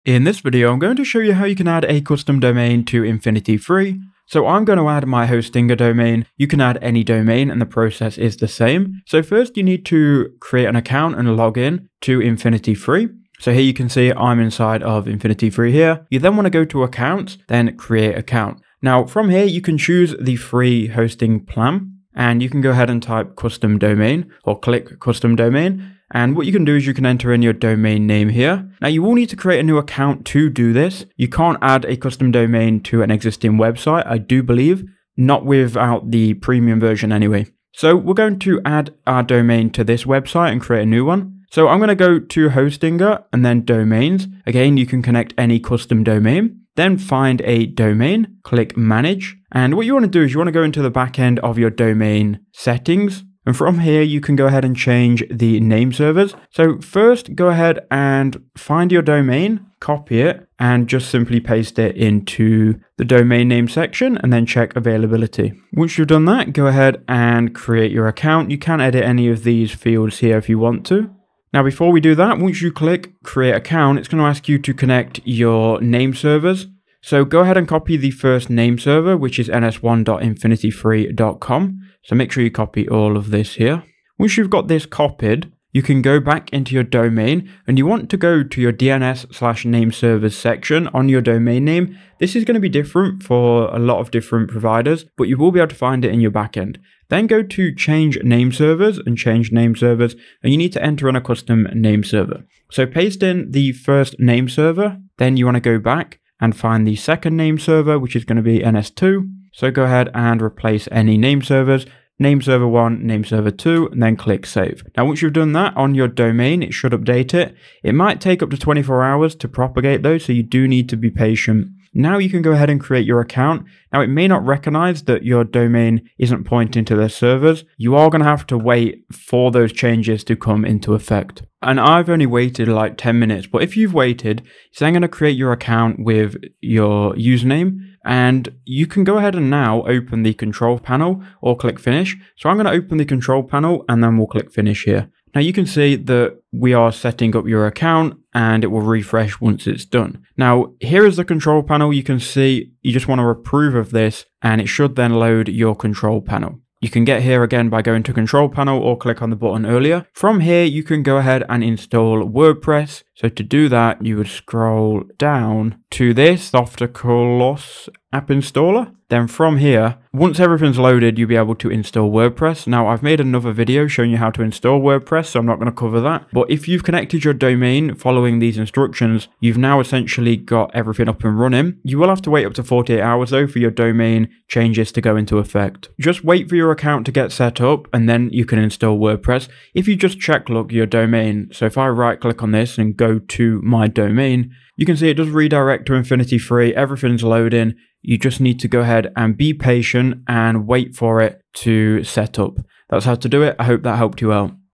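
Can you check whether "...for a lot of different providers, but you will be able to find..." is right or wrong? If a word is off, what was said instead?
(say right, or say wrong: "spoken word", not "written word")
right.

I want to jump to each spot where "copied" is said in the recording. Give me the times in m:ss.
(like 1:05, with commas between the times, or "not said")
1:24.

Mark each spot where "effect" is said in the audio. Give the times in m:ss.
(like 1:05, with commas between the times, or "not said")
2:10, 3:05.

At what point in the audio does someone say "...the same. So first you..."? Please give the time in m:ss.
0:08.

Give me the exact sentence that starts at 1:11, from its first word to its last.
Now, before we do that, once you click create account, it's going to ask you to connect your name servers.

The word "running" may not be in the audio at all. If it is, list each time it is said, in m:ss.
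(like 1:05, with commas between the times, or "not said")
3:01.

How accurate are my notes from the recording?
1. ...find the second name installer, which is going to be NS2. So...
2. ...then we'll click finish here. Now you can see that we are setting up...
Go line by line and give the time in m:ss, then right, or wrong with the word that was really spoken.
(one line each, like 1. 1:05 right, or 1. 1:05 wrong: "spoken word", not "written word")
1. 1:46 wrong: "server", not "installer"
2. 2:24 right.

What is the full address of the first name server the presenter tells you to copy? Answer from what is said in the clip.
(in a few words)
ns1.infinityfree.com.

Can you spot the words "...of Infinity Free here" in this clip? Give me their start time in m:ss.
0:14.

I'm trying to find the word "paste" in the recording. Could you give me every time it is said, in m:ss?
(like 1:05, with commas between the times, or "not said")
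1:01, 1:42.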